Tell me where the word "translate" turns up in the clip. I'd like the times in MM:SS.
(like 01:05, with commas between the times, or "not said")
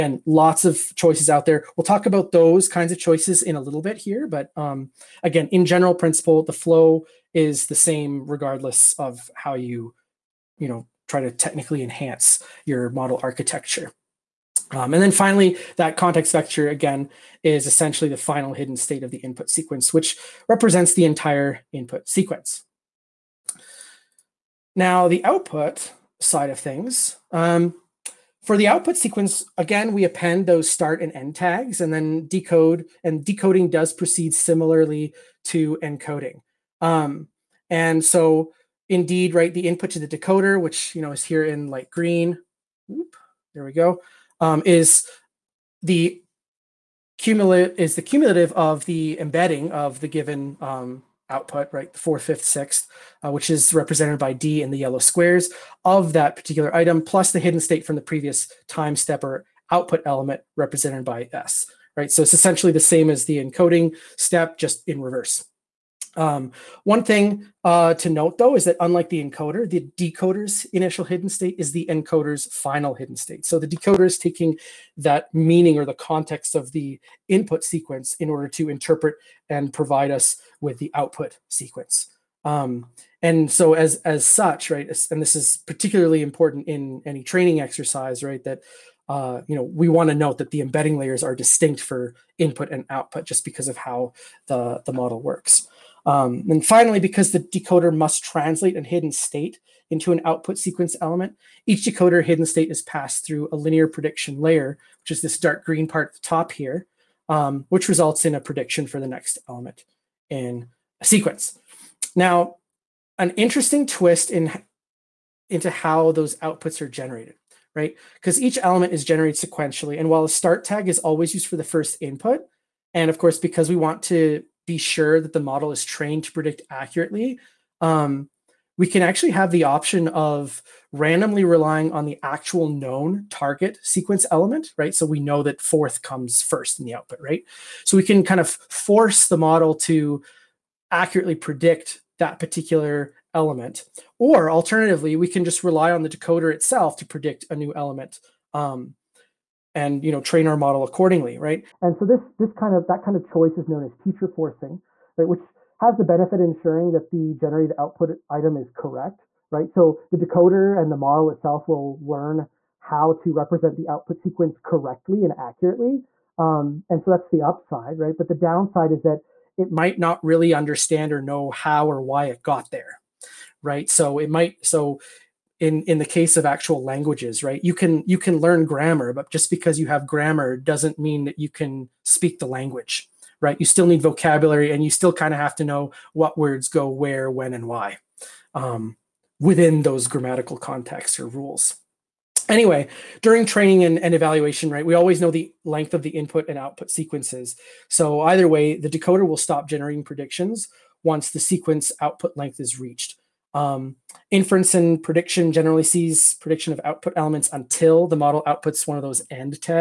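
01:38.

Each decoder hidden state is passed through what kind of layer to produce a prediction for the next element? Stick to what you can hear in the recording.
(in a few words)
linear prediction layer.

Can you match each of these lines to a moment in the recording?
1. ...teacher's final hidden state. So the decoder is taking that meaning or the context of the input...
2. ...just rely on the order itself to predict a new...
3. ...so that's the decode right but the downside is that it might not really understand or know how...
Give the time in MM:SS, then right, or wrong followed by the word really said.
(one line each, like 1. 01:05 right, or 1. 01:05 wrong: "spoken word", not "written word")
1. 01:11 wrong: "encoder", not "teacher"
2. 02:25 wrong: "decoder", not "order"
3. 02:47 wrong: "upside", not "decode".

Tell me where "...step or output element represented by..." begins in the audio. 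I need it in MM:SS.
00:58.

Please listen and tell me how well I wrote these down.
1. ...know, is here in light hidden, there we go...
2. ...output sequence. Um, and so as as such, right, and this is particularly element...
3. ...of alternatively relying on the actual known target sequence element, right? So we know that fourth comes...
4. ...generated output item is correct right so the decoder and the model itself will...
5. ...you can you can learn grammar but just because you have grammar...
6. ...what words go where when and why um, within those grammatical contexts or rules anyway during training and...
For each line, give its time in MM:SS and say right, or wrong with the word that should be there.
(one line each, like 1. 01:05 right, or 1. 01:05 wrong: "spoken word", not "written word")
1. 00:41 wrong: "green", not "hidden"
2. 01:20 wrong: "important", not "element"
3. 02:10 wrong: "randomly", not "alternatively"
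4. 02:37 right
5. 02:57 right
6. 03:06 right.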